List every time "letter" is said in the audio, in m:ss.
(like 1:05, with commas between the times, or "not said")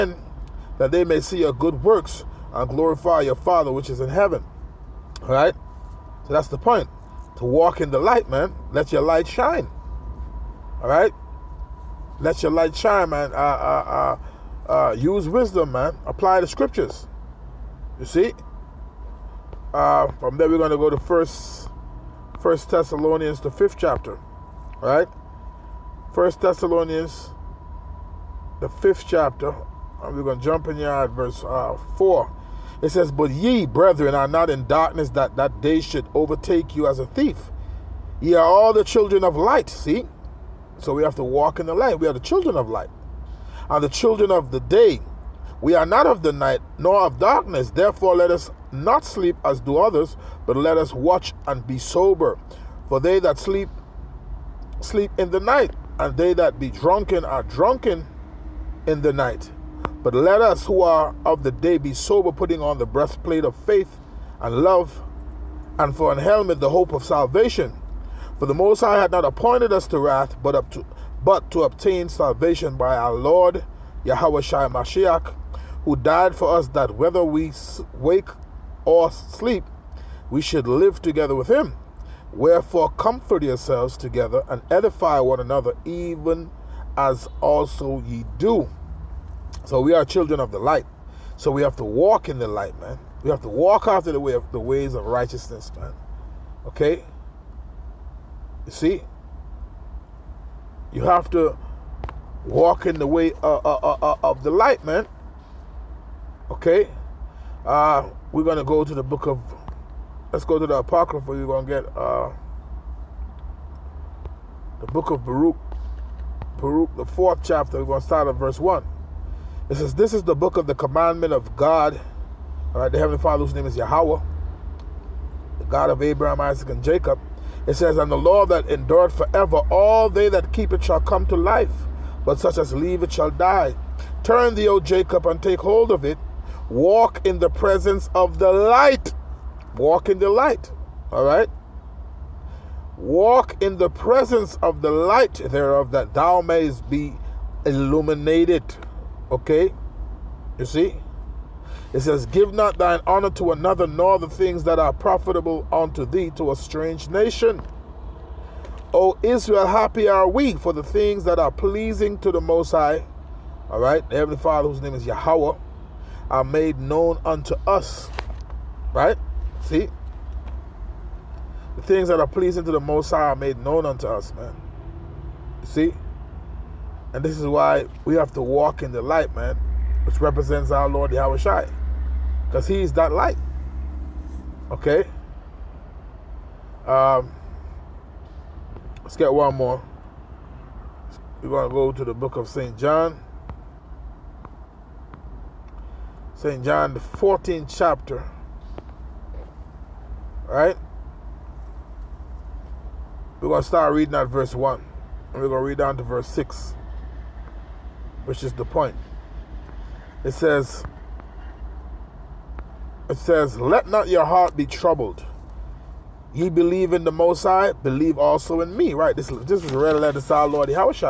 3:39.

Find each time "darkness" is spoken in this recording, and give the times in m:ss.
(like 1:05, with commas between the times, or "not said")
0:34, 0:47.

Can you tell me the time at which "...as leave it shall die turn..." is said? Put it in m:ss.
2:12.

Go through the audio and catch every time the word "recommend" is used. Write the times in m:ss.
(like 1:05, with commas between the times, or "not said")
not said.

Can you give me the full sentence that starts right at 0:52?
For they that sleep, sleep in the night, and they that be drunken are drunken in the night.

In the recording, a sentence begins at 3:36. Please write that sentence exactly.
Ye believe in the Most High, believe also in me.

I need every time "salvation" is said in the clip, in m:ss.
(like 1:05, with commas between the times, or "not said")
1:07, 1:12.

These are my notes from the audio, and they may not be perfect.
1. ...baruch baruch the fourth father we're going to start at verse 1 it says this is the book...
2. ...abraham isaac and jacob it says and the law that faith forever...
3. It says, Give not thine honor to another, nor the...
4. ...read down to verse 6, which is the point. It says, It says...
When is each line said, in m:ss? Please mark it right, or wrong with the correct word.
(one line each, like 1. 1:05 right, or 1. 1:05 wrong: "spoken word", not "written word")
1. 1:55 wrong: "chapter", not "father"
2. 2:06 wrong: "endureth", not "faith"
3. 2:31 right
4. 3:25 right.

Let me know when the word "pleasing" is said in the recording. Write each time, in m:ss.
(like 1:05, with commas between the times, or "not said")
2:41, 2:52.